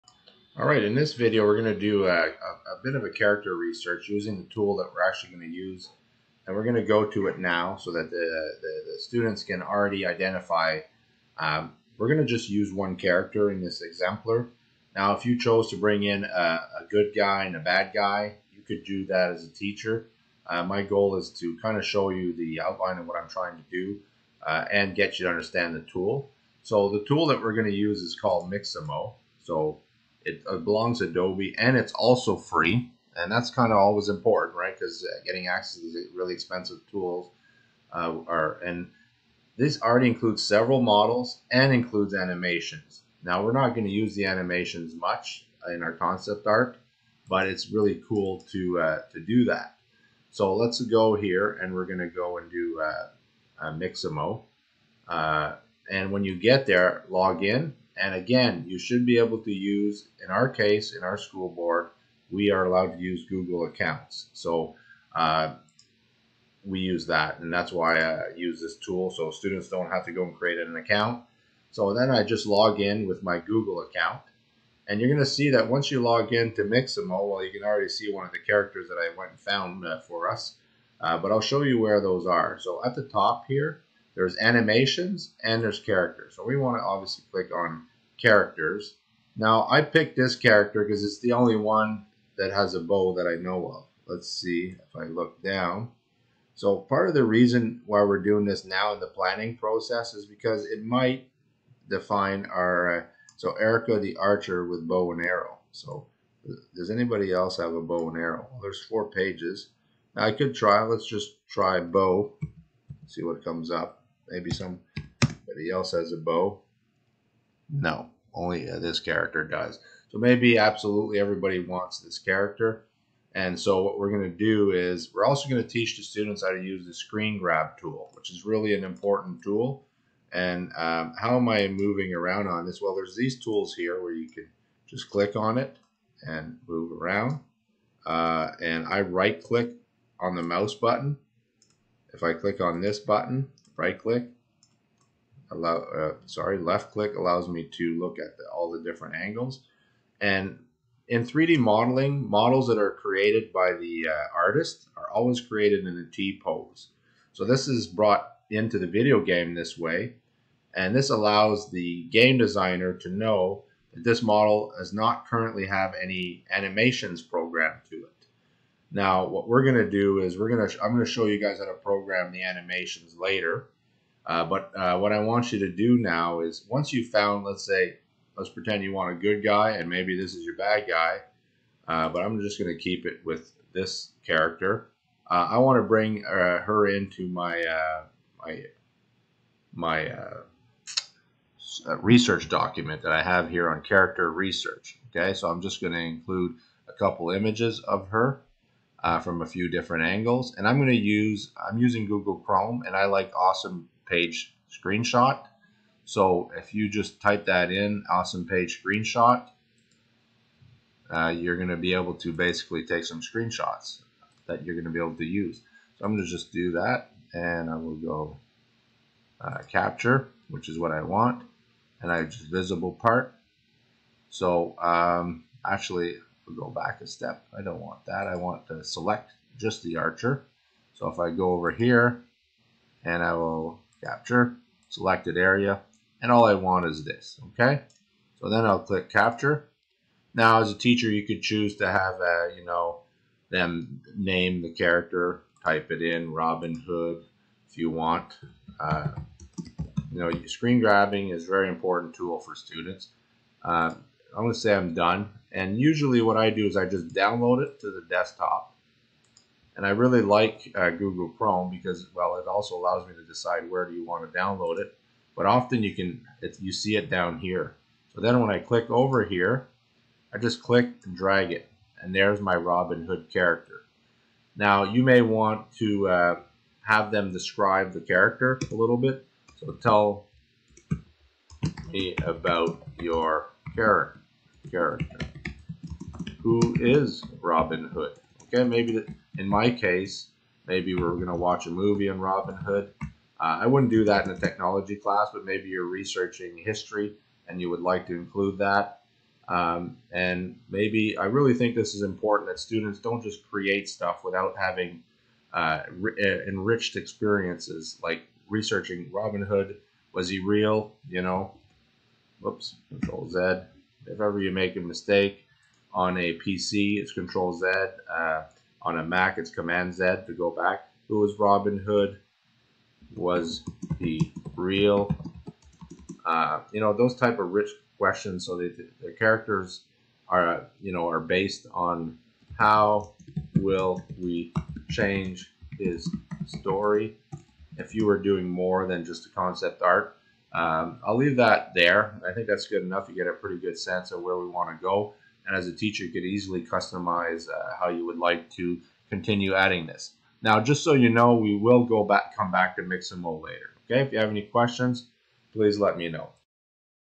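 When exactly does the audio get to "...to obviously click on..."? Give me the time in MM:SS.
01:26.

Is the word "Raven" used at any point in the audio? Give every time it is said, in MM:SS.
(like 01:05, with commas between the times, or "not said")
not said.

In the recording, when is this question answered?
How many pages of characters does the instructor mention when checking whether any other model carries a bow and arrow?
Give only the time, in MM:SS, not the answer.
01:48.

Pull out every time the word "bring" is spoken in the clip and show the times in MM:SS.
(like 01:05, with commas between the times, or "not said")
00:15, 03:05.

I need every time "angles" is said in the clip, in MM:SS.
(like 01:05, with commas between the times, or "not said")
02:29, 03:20.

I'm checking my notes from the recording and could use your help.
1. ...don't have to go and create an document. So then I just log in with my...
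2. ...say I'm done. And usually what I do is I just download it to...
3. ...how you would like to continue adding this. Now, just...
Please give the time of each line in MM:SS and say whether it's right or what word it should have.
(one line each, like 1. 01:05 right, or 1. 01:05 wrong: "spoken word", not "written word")
1. 01:09 wrong: "account", not "document"
2. 04:14 right
3. 05:47 right.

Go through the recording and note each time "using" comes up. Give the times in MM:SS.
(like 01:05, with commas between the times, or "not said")
00:04, 03:21.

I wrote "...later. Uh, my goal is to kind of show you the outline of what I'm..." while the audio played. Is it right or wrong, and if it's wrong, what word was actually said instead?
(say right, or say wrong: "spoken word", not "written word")
wrong: "teacher", not "later".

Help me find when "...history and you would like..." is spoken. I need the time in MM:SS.
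04:56.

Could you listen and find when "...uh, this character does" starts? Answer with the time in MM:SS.
01:58.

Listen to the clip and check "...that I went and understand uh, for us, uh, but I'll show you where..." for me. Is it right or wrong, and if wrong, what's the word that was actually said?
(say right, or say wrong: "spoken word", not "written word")
wrong: "found", not "understand".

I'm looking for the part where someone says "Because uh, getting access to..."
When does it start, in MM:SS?
00:34.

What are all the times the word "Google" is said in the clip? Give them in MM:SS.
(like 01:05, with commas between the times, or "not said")
01:03, 01:13, 03:22, 04:20.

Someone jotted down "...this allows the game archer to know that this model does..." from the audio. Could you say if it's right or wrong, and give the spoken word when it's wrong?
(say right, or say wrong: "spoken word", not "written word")
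wrong: "designer", not "archer".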